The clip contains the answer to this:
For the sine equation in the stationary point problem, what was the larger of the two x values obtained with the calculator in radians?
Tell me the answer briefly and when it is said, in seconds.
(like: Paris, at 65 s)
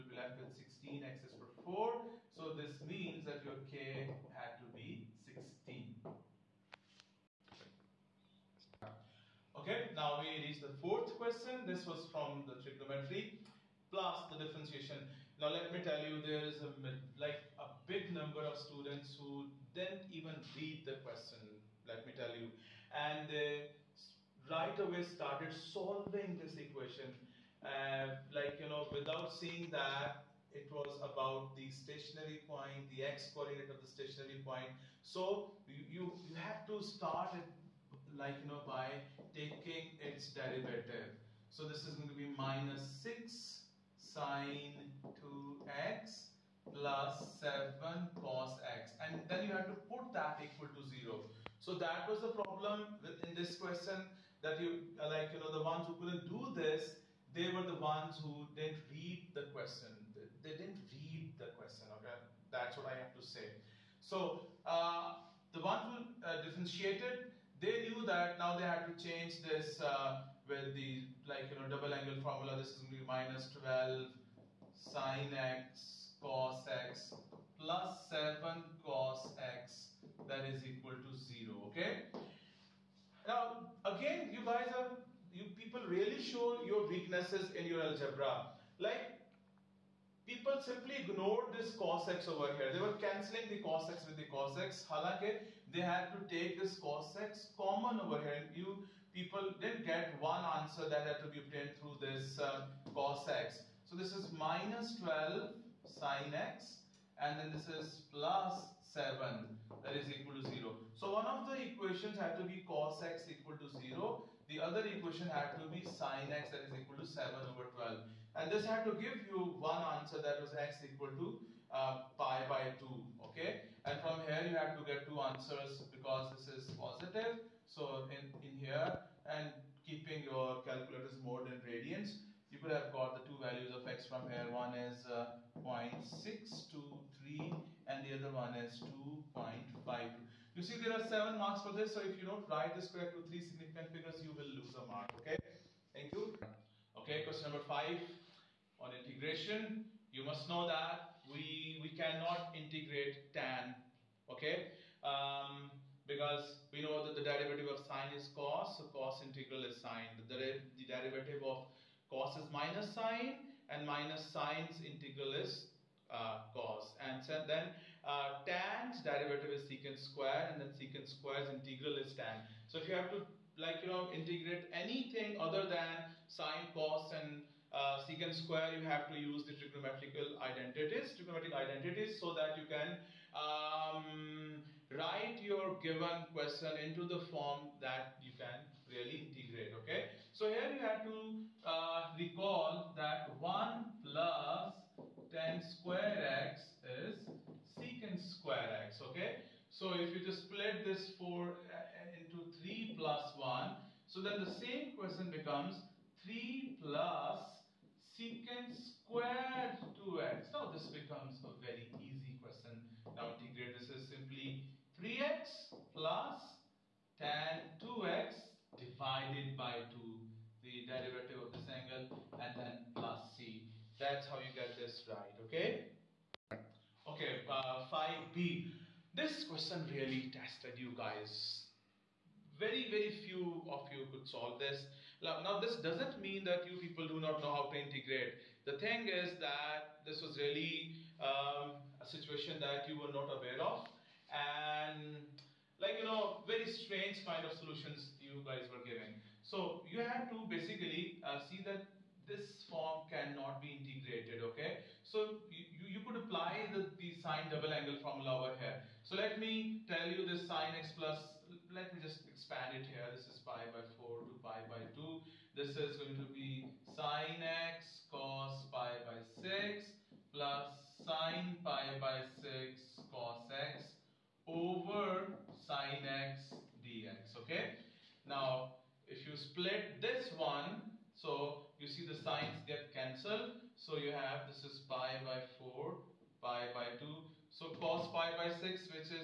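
2.52, at 138 s.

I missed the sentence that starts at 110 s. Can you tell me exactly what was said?
So one of the equations had to be cos x equal to 0.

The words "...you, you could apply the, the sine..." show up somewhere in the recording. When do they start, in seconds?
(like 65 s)
255 s.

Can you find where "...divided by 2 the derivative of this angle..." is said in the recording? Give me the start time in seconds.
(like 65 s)
218 s.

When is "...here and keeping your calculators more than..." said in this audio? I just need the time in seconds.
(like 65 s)
128 s.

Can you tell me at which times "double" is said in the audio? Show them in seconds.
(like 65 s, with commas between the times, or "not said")
71 s, 257 s.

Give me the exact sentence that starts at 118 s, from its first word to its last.
And this had to give you one answer that was x equal to uh, pi by 2.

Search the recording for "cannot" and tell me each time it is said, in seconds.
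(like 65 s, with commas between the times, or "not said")
151 s, 253 s.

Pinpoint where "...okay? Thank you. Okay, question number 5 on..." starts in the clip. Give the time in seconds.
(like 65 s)
145 s.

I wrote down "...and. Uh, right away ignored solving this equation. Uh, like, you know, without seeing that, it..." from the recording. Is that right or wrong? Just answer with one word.
wrong.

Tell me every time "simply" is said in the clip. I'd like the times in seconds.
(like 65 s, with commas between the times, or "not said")
90 s, 214 s.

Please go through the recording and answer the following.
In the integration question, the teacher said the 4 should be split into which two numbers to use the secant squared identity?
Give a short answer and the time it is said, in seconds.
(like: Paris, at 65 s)
3 and 1, at 202 s.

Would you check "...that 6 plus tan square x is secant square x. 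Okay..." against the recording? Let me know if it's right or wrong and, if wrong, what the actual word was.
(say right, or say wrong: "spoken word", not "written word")
wrong: "1", not "6".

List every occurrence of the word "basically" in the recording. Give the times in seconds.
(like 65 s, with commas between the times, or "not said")
250 s.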